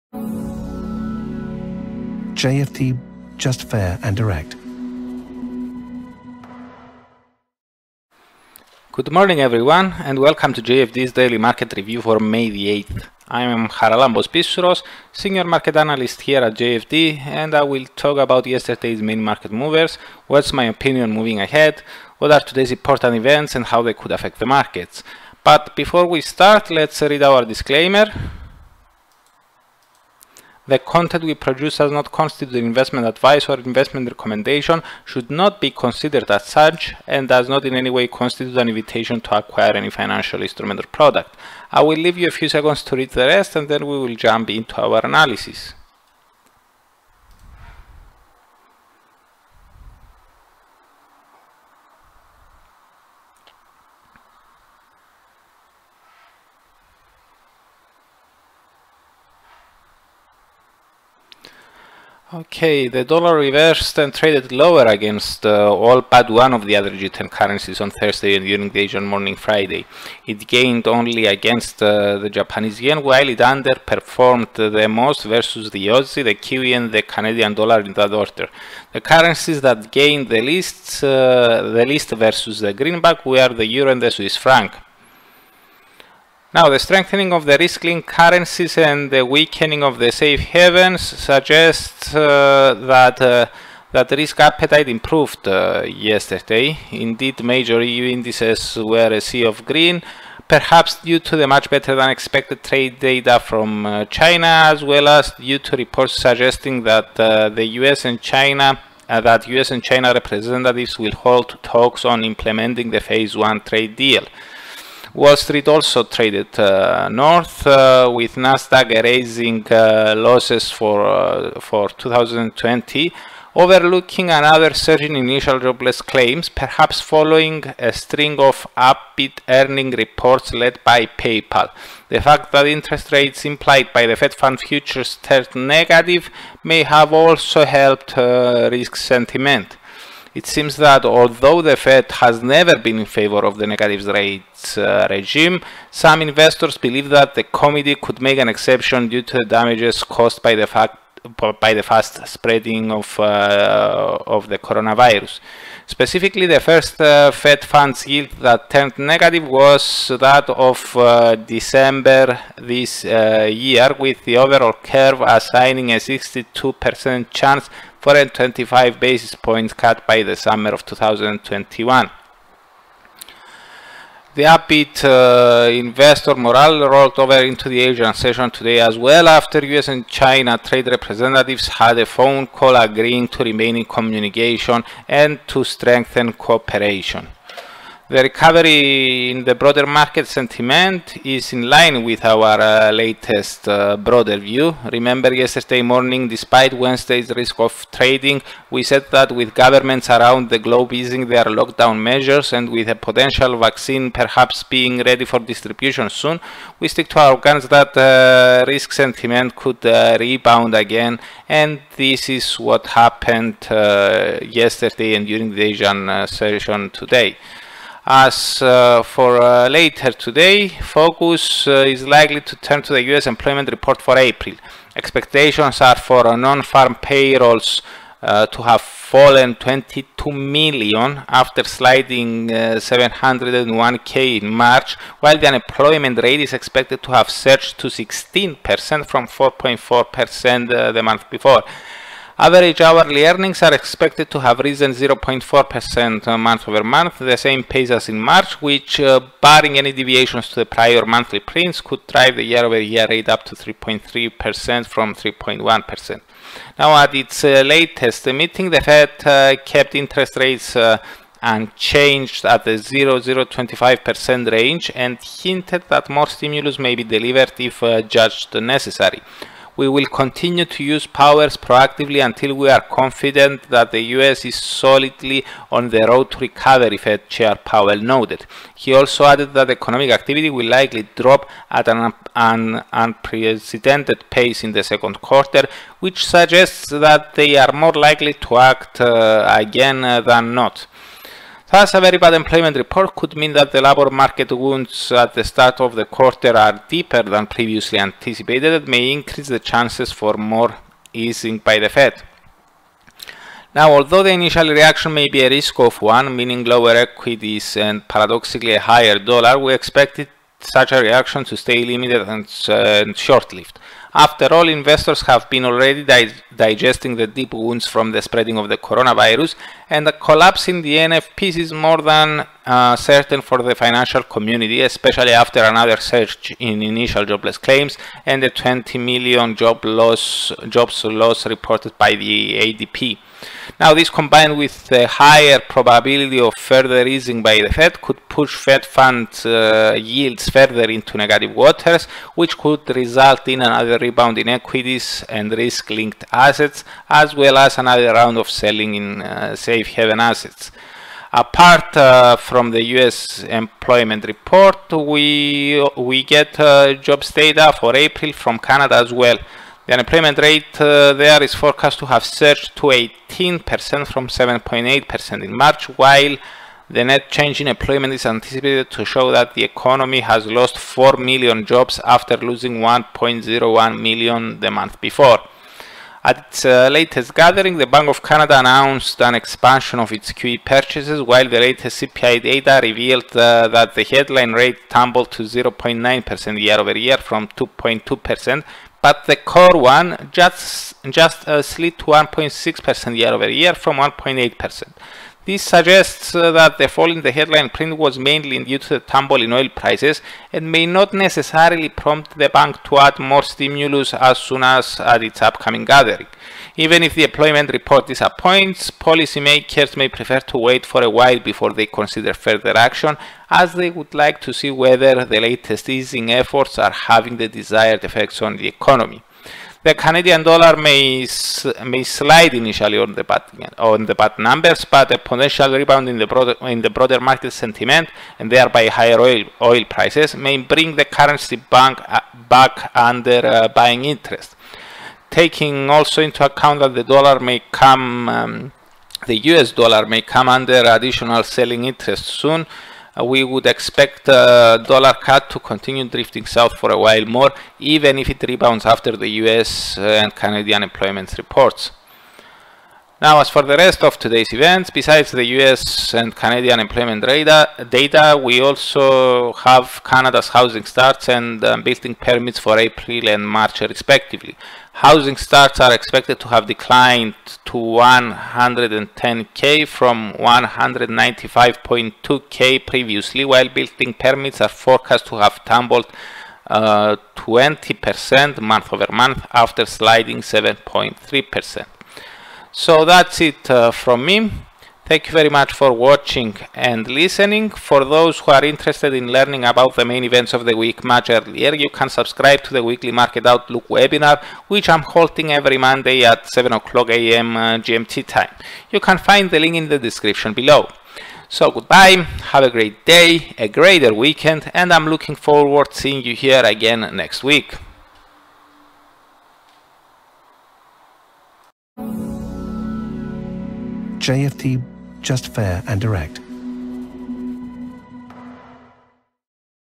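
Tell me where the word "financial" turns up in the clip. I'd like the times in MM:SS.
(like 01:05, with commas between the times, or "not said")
00:39, 05:23.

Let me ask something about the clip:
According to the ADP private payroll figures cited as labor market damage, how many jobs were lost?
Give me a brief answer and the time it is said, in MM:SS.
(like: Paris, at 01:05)
20 million, at 05:28.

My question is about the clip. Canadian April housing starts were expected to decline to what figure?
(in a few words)
110k.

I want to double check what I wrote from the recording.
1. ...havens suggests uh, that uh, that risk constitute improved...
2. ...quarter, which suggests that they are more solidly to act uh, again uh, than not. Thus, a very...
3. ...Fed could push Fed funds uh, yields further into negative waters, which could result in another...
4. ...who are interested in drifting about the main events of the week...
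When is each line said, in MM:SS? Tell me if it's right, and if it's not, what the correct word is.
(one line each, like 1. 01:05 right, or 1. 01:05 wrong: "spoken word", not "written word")
1. 01:30 wrong: "appetite", not "constitute"
2. 04:45 wrong: "likely", not "solidly"
3. 05:37 right
4. 08:08 wrong: "learning", not "drifting".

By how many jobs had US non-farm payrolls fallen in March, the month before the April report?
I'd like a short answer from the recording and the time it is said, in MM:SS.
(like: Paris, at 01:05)
701k, at 03:52.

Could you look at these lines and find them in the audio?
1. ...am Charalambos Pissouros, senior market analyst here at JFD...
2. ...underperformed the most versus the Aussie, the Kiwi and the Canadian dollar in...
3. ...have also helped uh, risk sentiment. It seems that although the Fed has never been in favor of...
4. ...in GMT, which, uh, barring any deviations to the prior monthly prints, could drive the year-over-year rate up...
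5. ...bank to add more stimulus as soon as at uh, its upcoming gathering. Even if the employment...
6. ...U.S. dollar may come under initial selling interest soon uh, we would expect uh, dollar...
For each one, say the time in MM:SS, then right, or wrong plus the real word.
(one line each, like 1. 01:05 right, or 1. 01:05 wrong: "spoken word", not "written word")
1. 00:13 right
2. 01:13 right
3. 02:16 right
4. 04:08 wrong: "March", not "GMT"
5. 06:42 right
6. 07:19 wrong: "additional", not "initial".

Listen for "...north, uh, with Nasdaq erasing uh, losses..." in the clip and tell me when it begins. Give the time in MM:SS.
01:57.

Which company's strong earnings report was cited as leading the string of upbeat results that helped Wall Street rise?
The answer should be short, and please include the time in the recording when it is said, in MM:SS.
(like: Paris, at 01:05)
PayPal, at 02:11.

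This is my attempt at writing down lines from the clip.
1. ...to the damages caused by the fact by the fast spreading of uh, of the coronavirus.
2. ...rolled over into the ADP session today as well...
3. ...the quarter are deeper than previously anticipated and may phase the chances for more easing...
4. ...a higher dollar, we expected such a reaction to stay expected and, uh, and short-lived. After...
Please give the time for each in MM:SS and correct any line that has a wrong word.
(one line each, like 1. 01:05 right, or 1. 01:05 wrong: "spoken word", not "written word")
1. 02:29 right
2. 02:56 wrong: "Asian", not "ADP"
3. 04:55 wrong: "increase", not "phase"
4. 05:08 wrong: "limited", not "expected".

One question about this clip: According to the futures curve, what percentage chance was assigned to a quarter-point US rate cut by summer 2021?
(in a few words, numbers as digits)
62%.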